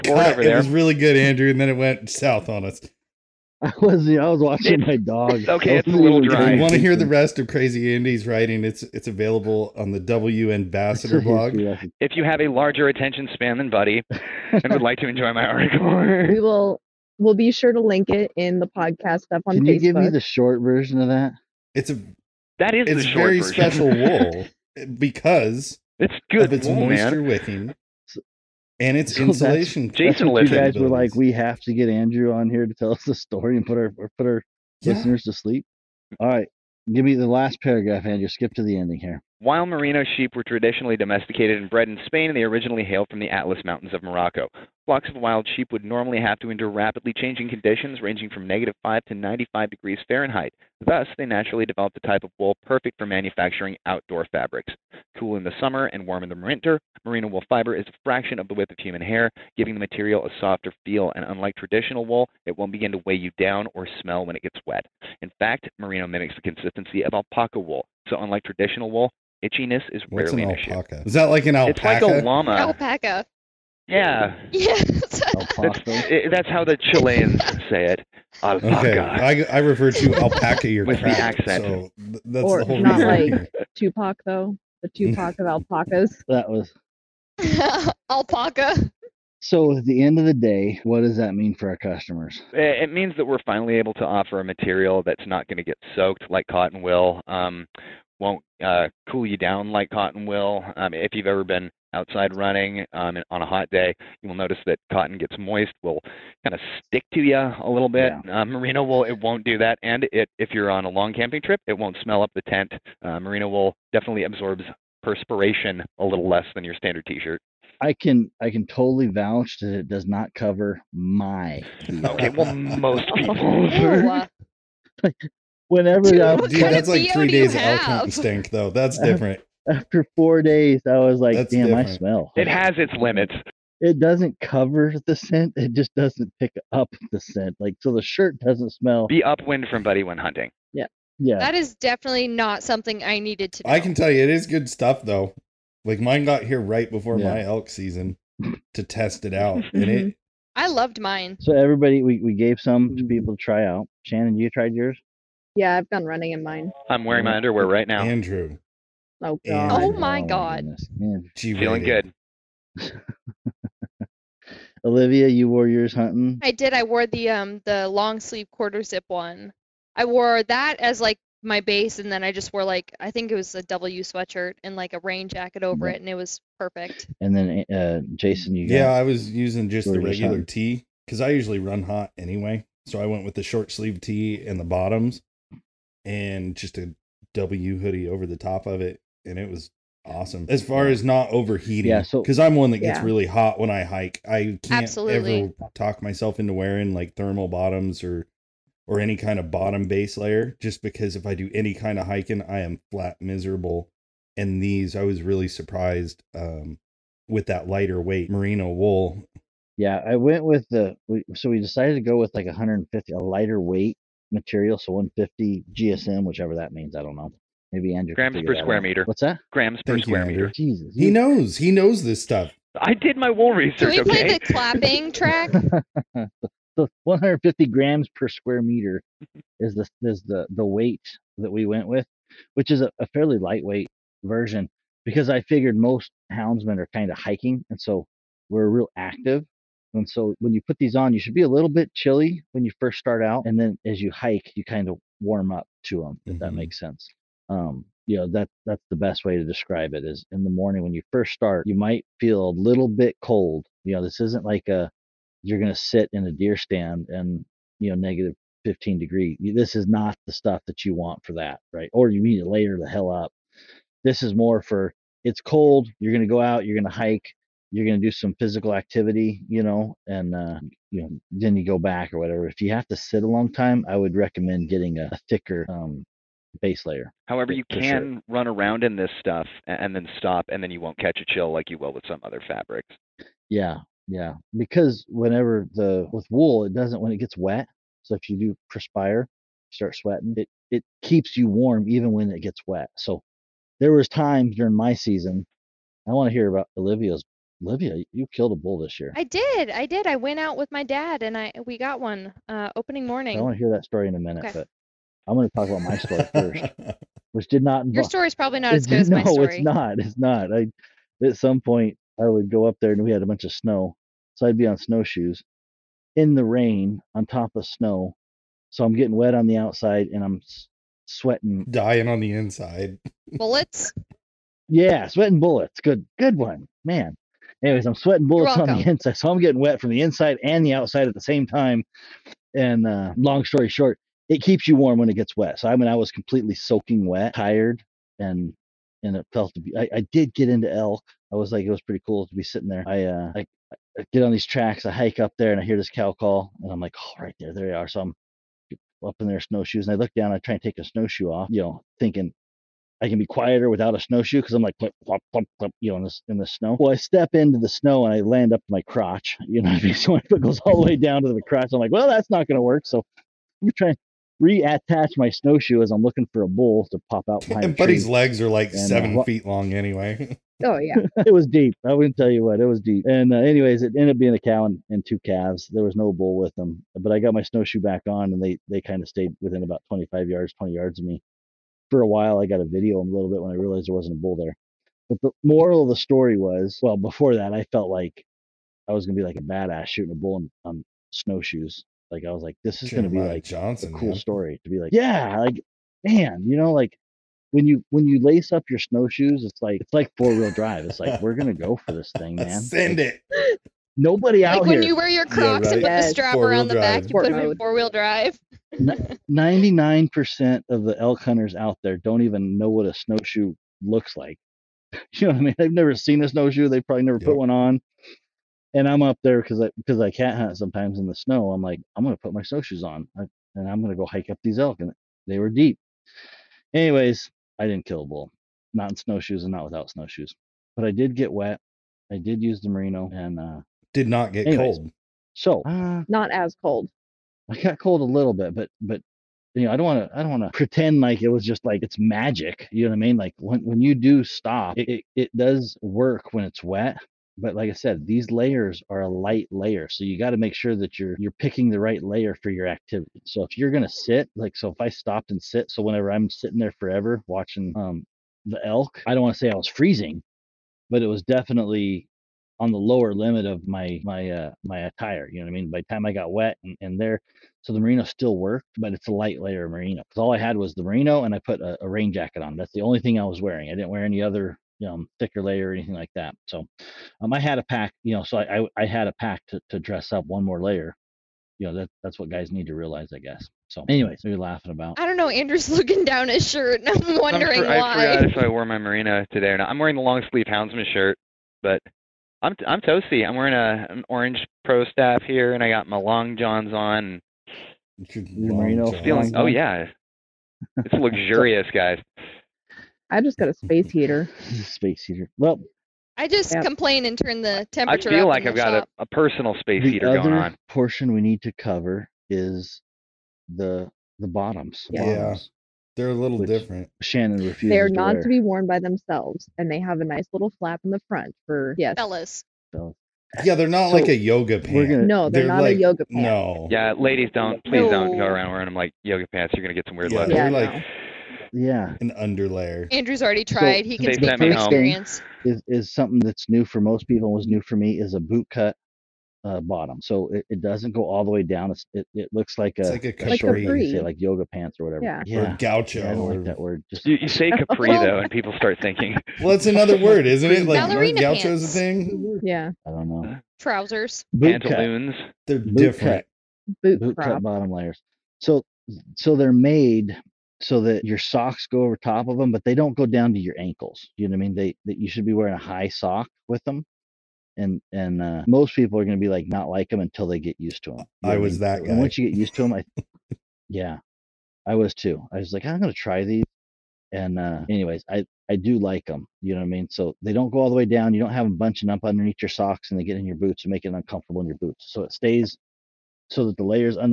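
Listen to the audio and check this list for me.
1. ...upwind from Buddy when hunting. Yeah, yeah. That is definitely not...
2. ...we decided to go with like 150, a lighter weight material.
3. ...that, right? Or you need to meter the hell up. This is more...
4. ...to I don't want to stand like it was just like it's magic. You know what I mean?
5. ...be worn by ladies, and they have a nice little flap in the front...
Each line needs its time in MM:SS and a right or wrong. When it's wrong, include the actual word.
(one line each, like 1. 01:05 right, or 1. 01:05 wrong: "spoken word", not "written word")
1. 02:19 right
2. 03:31 right
3. 04:21 wrong: "layer", not "meter"
4. 07:20 wrong: "pretend", not "stand"
5. 08:38 wrong: "themselves", not "ladies".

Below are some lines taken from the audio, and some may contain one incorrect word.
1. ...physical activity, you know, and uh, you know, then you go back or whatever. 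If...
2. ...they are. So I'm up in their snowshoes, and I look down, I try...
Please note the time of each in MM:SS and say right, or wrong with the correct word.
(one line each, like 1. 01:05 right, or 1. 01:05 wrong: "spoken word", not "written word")
1. 04:28 right
2. 05:47 right.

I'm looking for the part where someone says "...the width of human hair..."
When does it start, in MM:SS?
00:58.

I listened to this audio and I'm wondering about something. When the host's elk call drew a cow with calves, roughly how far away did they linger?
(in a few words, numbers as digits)
25 yards.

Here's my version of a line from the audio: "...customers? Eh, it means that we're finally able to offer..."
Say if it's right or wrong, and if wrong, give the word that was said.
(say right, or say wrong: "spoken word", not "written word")
right.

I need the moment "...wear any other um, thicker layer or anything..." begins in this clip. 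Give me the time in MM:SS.
07:53.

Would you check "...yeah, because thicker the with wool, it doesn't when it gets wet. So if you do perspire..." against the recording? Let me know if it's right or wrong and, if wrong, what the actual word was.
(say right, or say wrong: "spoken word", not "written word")
wrong: "whenever", not "thicker".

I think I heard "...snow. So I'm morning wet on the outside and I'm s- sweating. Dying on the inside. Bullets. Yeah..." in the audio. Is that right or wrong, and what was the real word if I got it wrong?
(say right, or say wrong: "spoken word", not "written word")
wrong: "getting", not "morning".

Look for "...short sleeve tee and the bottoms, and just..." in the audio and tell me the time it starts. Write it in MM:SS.
03:03.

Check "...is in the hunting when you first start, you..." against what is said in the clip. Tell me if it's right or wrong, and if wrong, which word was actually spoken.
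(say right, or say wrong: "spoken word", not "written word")
wrong: "morning", not "hunting".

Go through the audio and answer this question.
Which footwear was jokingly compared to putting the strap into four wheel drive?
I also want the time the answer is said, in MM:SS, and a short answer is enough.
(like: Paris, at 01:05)
Crocs, at 06:45.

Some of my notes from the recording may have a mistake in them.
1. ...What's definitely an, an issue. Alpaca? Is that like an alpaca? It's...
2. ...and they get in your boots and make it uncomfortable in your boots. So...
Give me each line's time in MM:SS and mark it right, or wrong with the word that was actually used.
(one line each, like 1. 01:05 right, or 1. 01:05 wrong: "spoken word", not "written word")
1. 01:10 wrong: "rarely", not "definitely"
2. 09:42 right.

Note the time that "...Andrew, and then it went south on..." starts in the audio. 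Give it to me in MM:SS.
00:01.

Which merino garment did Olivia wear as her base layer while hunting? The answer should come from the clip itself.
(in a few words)
Long sleeve quarter zip.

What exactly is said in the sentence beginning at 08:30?
Portion we need to cover is the the bottoms.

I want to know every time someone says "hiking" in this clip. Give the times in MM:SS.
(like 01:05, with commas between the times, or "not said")
03:22, 03:57.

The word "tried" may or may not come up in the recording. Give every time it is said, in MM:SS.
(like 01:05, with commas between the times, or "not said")
02:34, 08:53.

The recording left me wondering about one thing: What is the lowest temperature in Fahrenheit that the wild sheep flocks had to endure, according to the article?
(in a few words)
-5.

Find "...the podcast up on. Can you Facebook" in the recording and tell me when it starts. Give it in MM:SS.
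00:18.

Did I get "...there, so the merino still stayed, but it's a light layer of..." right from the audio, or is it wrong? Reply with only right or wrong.
wrong.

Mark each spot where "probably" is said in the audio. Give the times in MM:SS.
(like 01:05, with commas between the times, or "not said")
05:08, 06:56.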